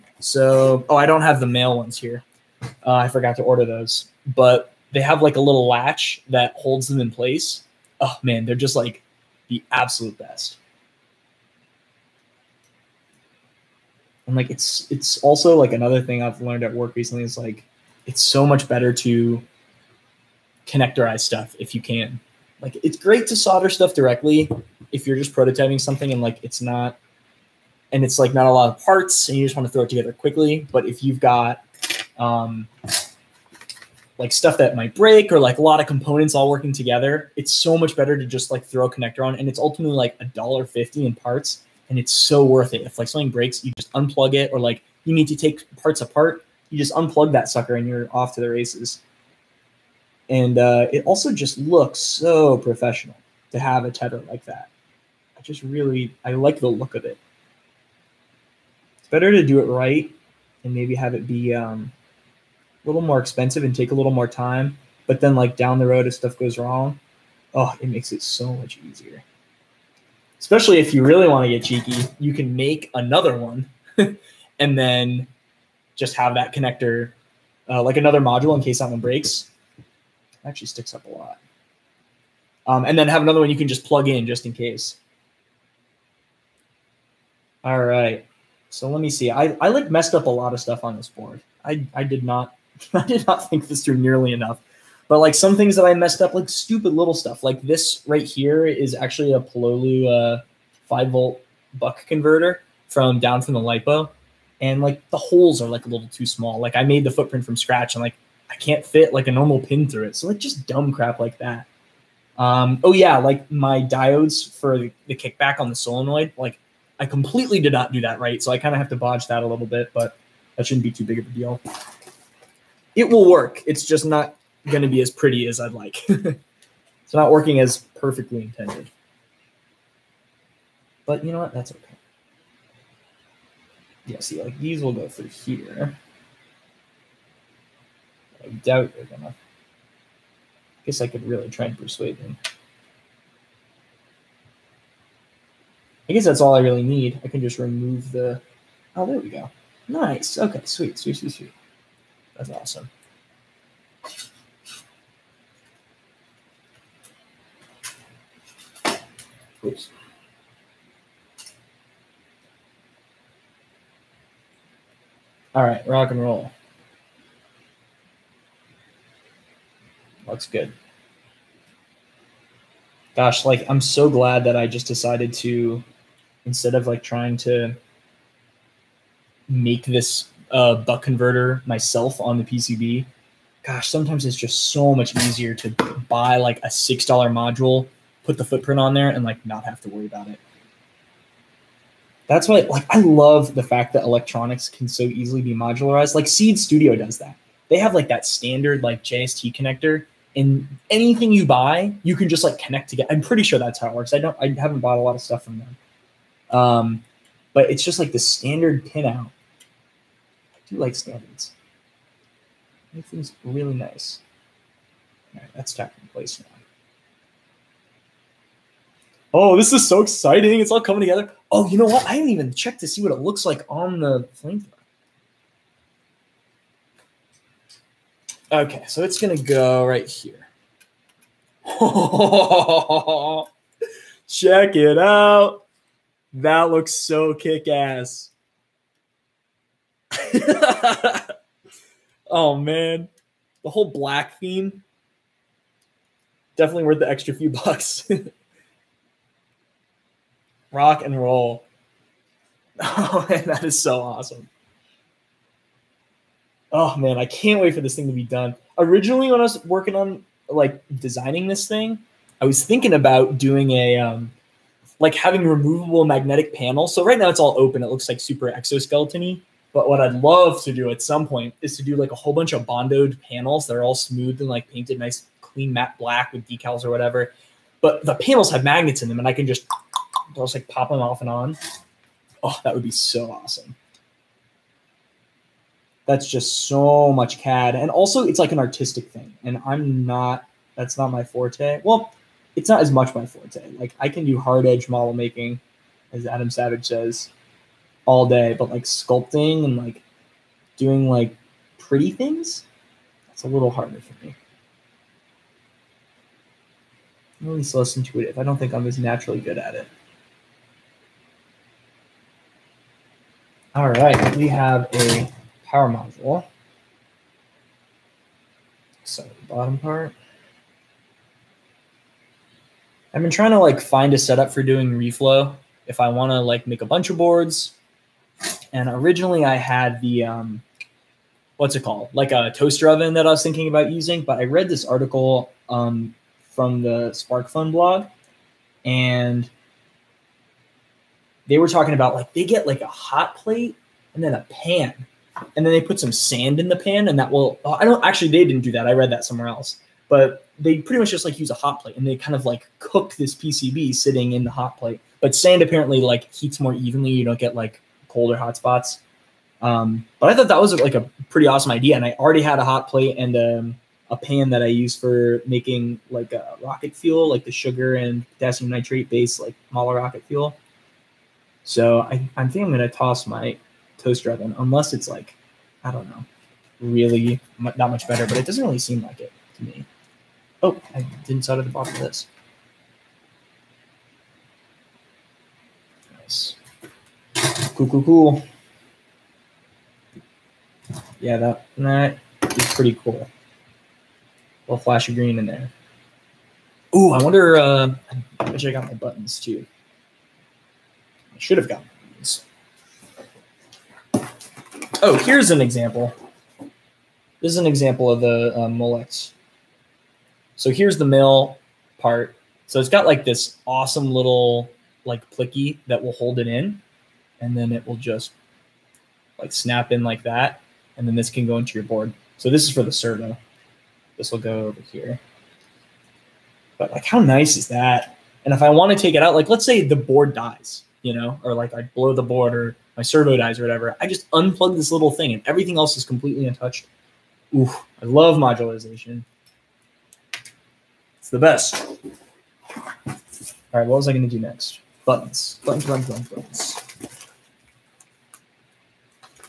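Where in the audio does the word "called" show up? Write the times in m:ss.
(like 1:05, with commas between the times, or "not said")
5:31.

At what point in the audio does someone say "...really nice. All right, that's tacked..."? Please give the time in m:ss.
3:33.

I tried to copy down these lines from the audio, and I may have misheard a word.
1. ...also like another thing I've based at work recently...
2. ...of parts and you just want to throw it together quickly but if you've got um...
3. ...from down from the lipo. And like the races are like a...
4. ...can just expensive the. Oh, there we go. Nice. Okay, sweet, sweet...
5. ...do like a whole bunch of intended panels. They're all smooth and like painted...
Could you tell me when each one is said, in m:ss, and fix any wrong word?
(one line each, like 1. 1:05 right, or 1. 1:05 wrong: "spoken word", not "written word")
1. 0:15 wrong: "learned", not "based"
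2. 0:28 right
3. 1:42 wrong: "holes", not "races"
4. 2:27 wrong: "remove", not "expensive"
5. 4:31 wrong: "bondoed", not "intended".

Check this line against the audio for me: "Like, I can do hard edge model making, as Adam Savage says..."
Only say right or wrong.
right.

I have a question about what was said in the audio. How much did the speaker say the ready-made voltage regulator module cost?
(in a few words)
6 dollars.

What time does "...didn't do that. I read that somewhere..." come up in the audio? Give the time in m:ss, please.
5:48.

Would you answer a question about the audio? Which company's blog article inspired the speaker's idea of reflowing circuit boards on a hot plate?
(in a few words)
SparkFun.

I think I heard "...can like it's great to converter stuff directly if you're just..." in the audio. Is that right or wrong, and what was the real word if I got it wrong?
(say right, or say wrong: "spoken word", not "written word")
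wrong: "solder", not "converter".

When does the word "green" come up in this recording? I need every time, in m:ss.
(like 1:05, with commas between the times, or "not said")
6:35.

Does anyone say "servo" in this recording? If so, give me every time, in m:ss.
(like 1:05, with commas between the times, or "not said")
7:02, 7:13.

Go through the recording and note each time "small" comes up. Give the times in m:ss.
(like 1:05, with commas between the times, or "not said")
1:46.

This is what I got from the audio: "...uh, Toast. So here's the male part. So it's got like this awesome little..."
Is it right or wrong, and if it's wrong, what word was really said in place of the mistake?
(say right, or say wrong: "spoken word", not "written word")
wrong: "Molex", not "Toast".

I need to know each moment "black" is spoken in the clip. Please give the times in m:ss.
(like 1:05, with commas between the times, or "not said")
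4:03, 4:35.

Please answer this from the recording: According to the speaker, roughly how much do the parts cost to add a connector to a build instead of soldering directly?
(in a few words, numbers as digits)
$1.50.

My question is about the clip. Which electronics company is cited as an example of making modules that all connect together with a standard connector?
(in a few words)
Seeed Studio.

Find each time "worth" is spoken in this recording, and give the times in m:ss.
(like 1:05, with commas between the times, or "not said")
0:42, 4:06.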